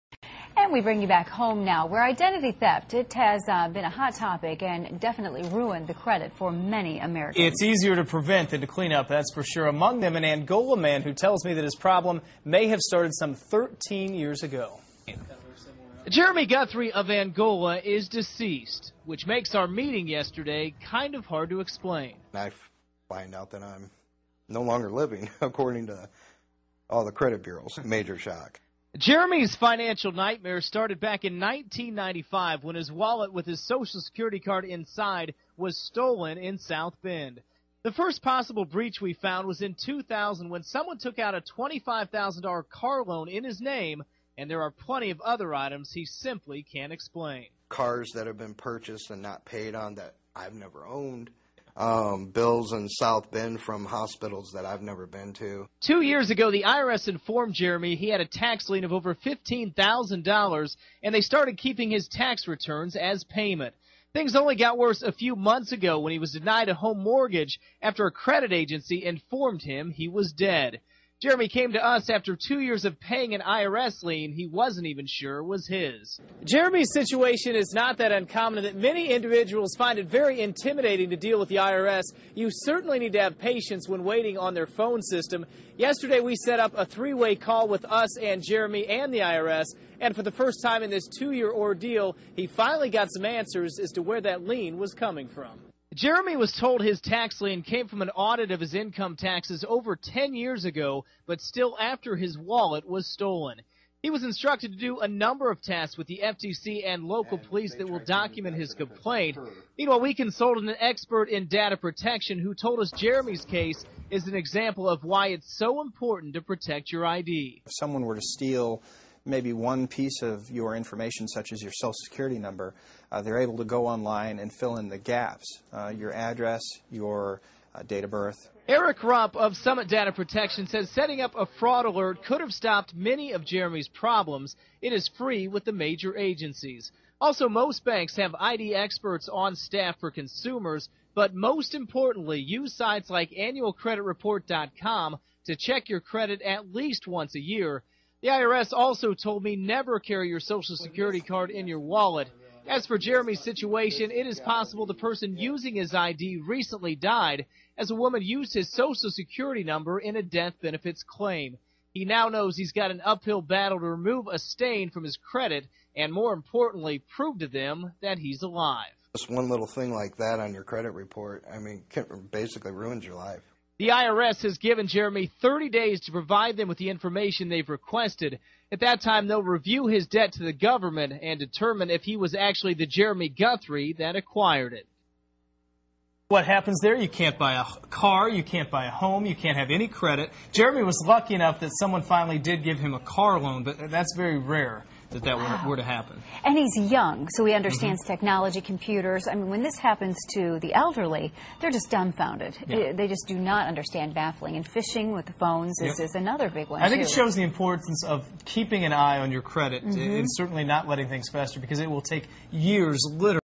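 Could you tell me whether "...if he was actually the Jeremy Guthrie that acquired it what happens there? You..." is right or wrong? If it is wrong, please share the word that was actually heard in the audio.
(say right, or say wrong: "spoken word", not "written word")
right.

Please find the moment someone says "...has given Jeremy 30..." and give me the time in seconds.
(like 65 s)
174 s.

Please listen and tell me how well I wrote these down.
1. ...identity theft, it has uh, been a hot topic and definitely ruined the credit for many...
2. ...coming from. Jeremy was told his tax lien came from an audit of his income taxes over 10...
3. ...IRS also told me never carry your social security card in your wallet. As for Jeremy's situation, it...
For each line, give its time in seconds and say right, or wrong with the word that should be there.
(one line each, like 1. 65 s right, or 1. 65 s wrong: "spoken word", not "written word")
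1. 2 s right
2. 94 s right
3. 148 s right.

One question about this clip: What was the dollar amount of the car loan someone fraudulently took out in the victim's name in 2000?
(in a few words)
$25,000.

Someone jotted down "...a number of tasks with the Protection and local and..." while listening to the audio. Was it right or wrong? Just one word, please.
wrong.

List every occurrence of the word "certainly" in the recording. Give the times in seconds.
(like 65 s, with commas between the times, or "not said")
82 s, 210 s.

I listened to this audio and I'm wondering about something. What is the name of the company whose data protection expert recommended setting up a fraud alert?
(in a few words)
Summit Data Protection.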